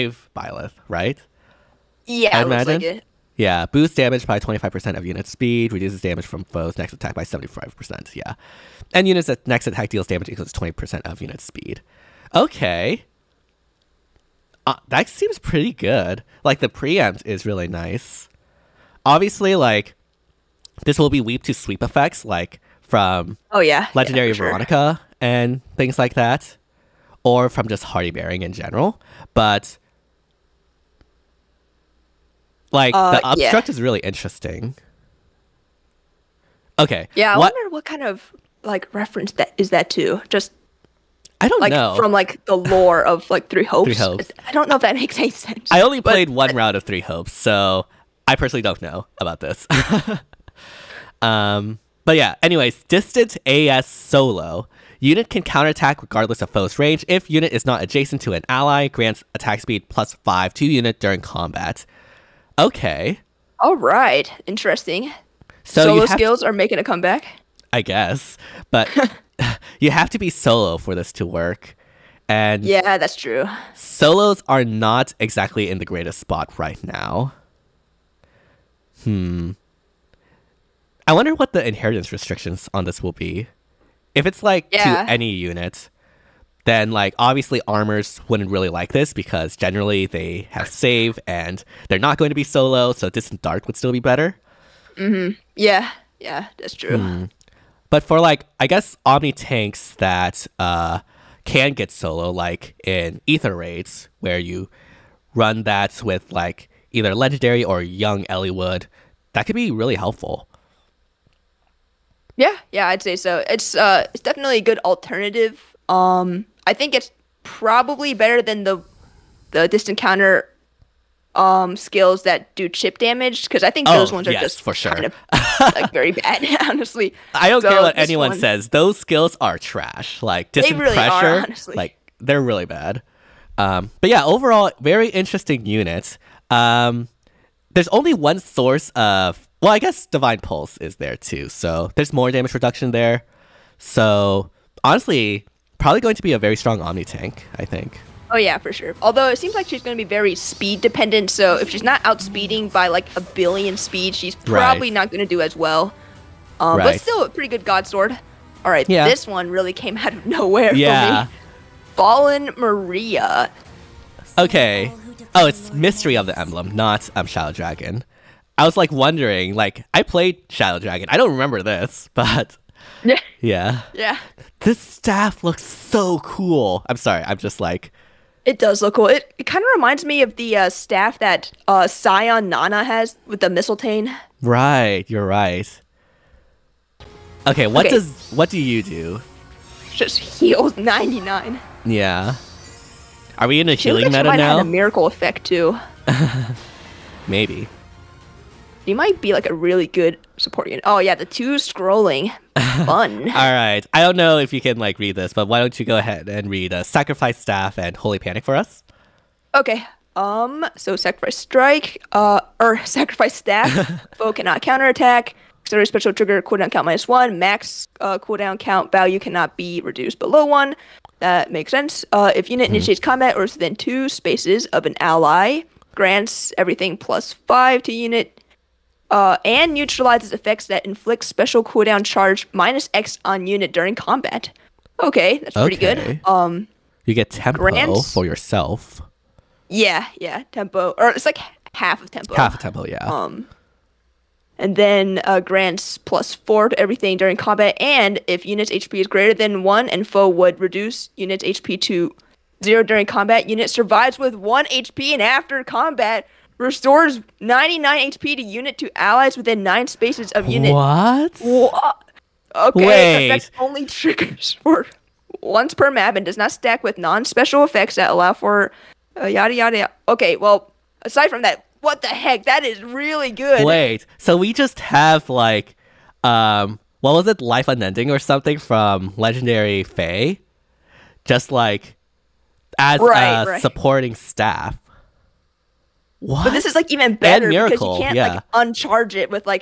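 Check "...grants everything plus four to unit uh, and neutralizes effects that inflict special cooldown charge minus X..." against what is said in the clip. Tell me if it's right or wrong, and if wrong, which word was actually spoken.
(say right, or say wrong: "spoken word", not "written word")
wrong: "five", not "four".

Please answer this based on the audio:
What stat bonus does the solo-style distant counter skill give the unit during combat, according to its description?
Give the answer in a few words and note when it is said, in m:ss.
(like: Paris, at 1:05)
Attack speed plus 5, at 0:59.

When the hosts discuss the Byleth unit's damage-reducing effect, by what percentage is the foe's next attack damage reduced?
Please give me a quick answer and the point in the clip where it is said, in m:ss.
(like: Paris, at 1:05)
75%, at 0:07.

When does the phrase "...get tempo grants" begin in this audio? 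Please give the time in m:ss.
3:57.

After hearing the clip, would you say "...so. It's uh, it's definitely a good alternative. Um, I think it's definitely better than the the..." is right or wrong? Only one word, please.
wrong.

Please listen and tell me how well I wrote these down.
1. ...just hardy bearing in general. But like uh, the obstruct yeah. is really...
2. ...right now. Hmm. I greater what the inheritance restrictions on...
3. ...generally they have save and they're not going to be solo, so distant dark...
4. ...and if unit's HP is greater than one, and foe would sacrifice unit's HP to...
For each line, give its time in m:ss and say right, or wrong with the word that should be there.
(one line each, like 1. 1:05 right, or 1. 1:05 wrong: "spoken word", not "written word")
1. 0:27 right
2. 1:16 wrong: "wonder", not "greater"
3. 1:29 right
4. 4:07 wrong: "reduce", not "sacrifice".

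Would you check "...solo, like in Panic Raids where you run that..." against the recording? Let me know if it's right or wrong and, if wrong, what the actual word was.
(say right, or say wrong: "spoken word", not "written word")
wrong: "Aether", not "Panic".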